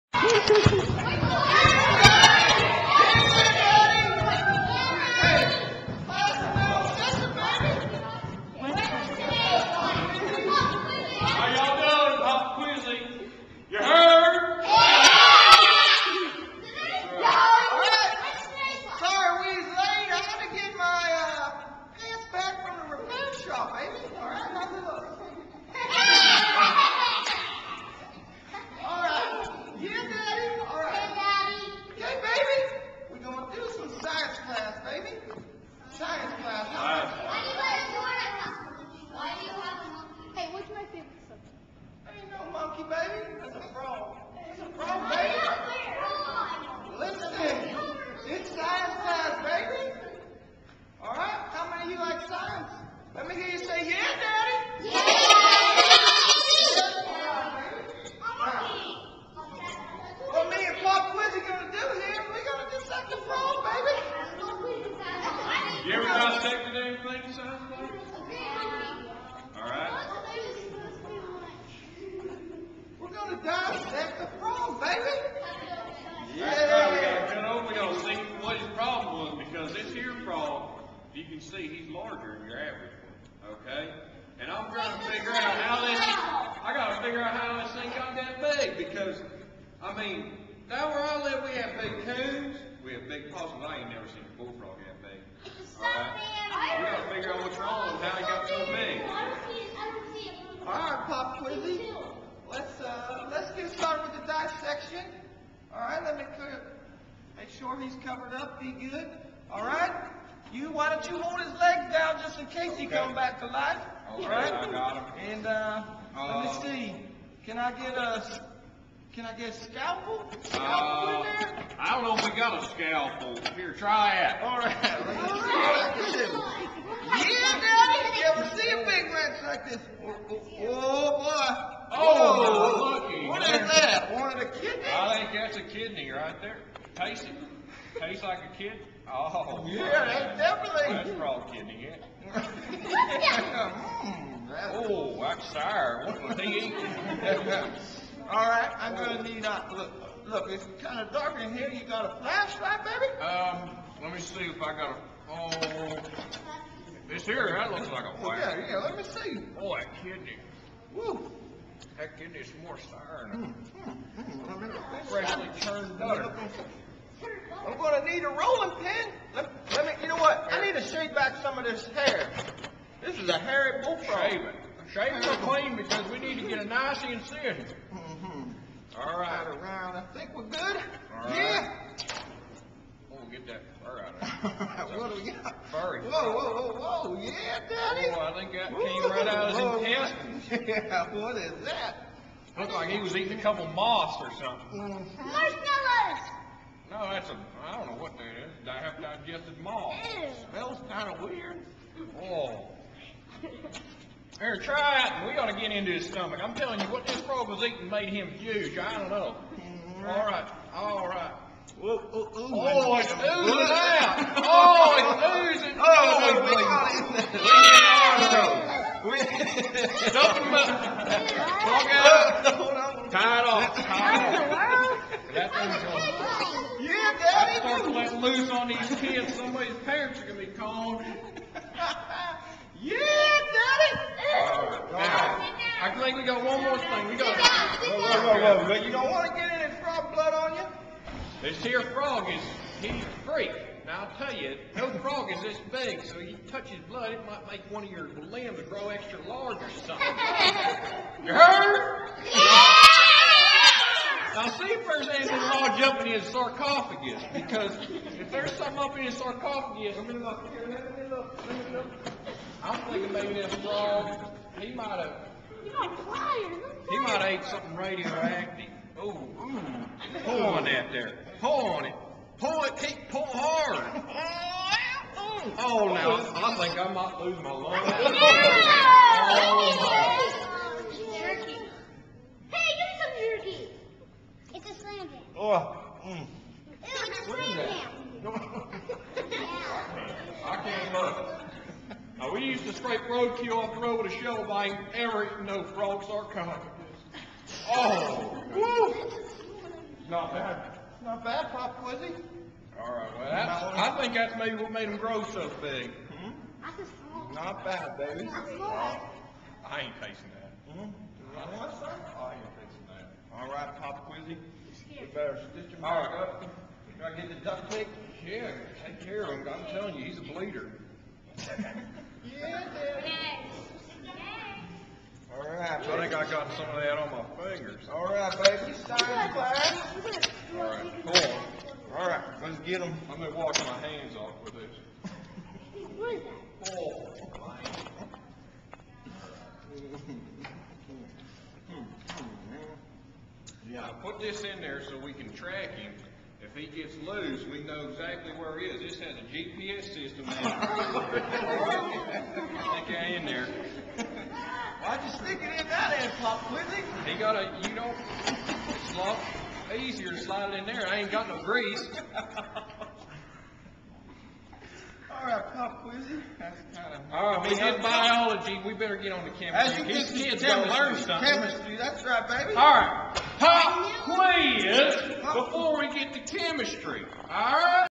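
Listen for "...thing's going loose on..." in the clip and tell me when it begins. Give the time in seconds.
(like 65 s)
225 s.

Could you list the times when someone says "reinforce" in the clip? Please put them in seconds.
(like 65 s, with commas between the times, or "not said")
not said.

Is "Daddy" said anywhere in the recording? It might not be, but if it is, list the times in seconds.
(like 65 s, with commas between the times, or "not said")
127 s, 187 s, 322 s.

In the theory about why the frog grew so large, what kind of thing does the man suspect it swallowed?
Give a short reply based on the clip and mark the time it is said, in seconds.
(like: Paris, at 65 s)
something radioactive, at 267 s.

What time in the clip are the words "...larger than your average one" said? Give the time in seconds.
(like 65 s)
81 s.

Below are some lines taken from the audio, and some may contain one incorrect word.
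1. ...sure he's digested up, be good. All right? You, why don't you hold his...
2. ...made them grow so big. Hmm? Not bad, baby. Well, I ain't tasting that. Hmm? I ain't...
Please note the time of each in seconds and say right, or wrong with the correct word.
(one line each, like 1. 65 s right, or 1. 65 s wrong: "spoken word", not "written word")
1. 107 s wrong: "covered", not "digested"
2. 304 s right.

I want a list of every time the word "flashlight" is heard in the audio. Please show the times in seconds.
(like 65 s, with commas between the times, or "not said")
152 s, 158 s.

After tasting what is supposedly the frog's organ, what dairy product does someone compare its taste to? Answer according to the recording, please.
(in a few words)
Freshly churned butter.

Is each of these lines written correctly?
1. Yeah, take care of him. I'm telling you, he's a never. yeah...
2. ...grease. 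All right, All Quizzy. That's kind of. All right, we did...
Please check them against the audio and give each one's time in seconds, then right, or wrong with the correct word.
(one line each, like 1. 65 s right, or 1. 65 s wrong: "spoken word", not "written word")
1. 318 s wrong: "bleeder", not "never"
2. 361 s wrong: "Pop", not "All".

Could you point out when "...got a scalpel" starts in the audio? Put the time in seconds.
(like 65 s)
122 s.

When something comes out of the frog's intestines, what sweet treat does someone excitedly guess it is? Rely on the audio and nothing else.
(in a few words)
Marshmallows.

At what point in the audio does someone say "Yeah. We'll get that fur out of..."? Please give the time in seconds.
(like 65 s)
181 s.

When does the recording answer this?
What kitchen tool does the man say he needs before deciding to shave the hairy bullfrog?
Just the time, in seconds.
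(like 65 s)
168 s.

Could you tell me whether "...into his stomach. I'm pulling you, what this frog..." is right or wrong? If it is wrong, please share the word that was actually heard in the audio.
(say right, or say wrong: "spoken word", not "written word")
wrong: "telling", not "pulling".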